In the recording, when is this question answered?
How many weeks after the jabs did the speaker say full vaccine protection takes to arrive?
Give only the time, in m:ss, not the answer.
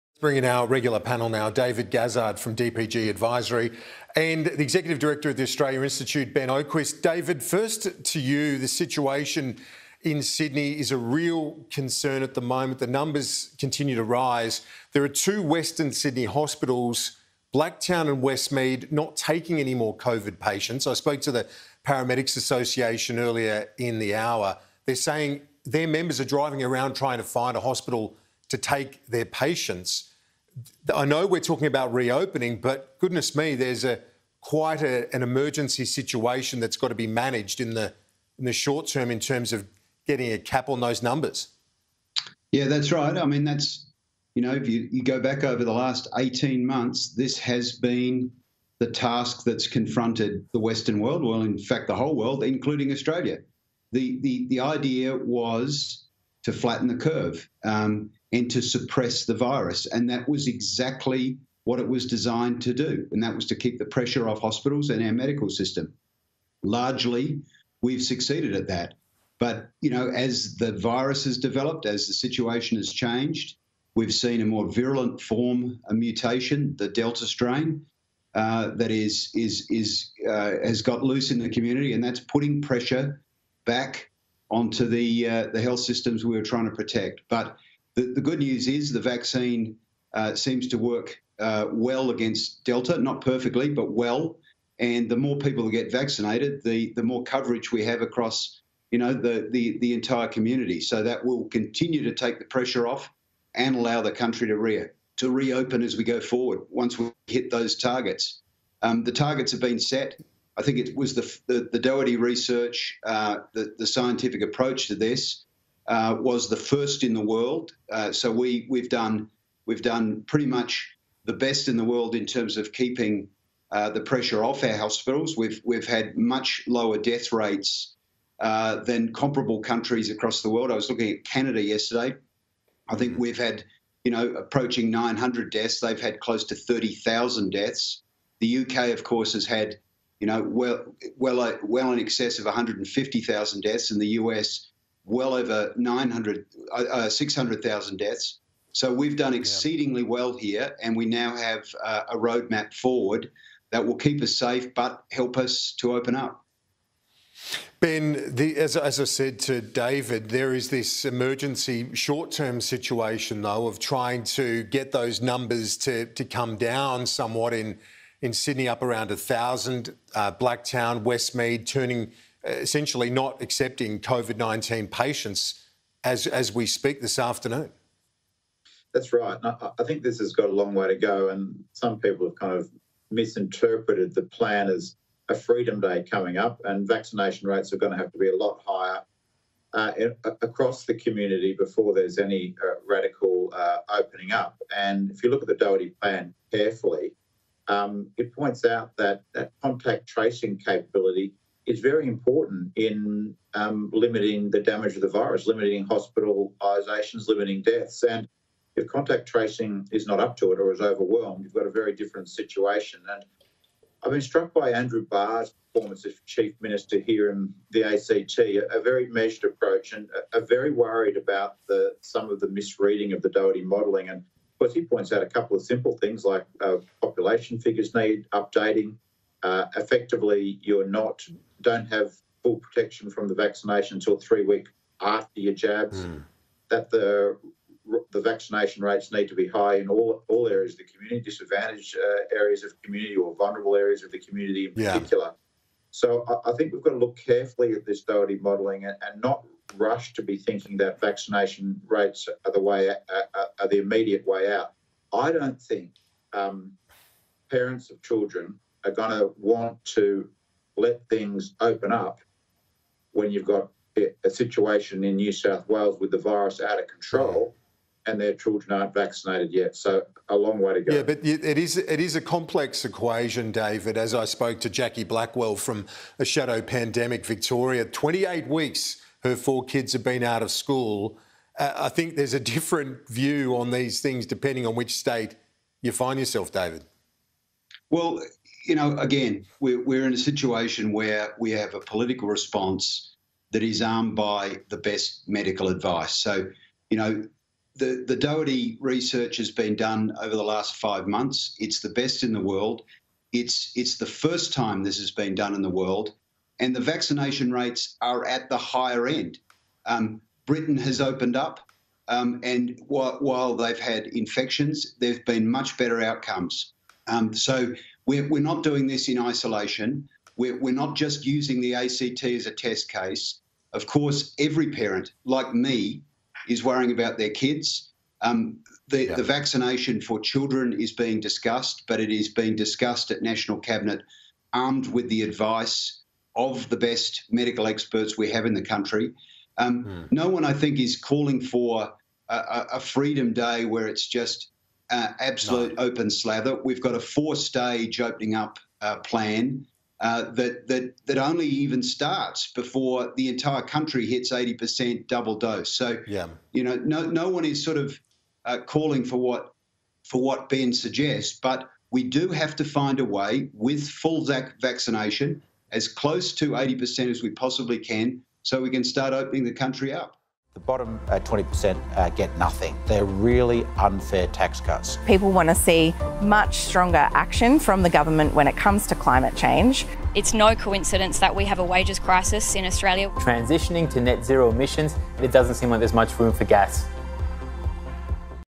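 3:54.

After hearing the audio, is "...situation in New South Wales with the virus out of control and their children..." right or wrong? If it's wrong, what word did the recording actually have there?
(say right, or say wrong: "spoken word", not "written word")
right.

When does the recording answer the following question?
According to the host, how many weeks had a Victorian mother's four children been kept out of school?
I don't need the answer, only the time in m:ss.
4:37.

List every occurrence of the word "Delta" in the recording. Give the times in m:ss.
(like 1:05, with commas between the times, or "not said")
1:16, 1:32.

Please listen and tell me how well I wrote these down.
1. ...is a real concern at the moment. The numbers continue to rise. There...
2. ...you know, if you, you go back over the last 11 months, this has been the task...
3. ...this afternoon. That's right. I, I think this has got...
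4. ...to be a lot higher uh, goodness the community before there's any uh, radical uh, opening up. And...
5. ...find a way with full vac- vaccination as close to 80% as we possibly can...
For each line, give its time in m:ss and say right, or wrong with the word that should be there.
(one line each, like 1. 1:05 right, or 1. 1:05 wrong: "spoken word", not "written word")
1. 0:10 right
2. 0:44 wrong: "18", not "11"
3. 2:57 right
4. 3:08 wrong: "across", not "goodness"
5. 6:02 right.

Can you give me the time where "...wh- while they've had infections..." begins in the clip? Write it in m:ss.
5:12.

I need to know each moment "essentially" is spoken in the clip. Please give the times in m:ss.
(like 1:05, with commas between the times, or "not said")
2:52.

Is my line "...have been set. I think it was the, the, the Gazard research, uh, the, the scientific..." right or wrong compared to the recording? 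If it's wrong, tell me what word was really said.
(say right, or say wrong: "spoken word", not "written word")
wrong: "Doherty", not "Gazard".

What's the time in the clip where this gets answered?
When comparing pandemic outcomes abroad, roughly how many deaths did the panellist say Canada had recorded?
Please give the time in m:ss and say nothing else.
2:16.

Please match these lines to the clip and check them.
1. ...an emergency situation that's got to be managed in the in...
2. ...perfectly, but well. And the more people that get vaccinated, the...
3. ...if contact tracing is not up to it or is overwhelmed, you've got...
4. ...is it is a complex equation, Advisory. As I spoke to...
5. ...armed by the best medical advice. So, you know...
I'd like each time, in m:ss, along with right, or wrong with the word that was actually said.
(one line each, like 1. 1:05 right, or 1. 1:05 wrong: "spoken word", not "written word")
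1. 0:35 right
2. 1:33 right
3. 3:28 right
4. 4:31 wrong: "David", not "Advisory"
5. 4:53 right.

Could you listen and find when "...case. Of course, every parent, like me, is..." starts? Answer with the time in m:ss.
5:22.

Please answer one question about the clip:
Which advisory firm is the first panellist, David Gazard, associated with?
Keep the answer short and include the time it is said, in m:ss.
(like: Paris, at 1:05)
DPG Advisory, at 0:02.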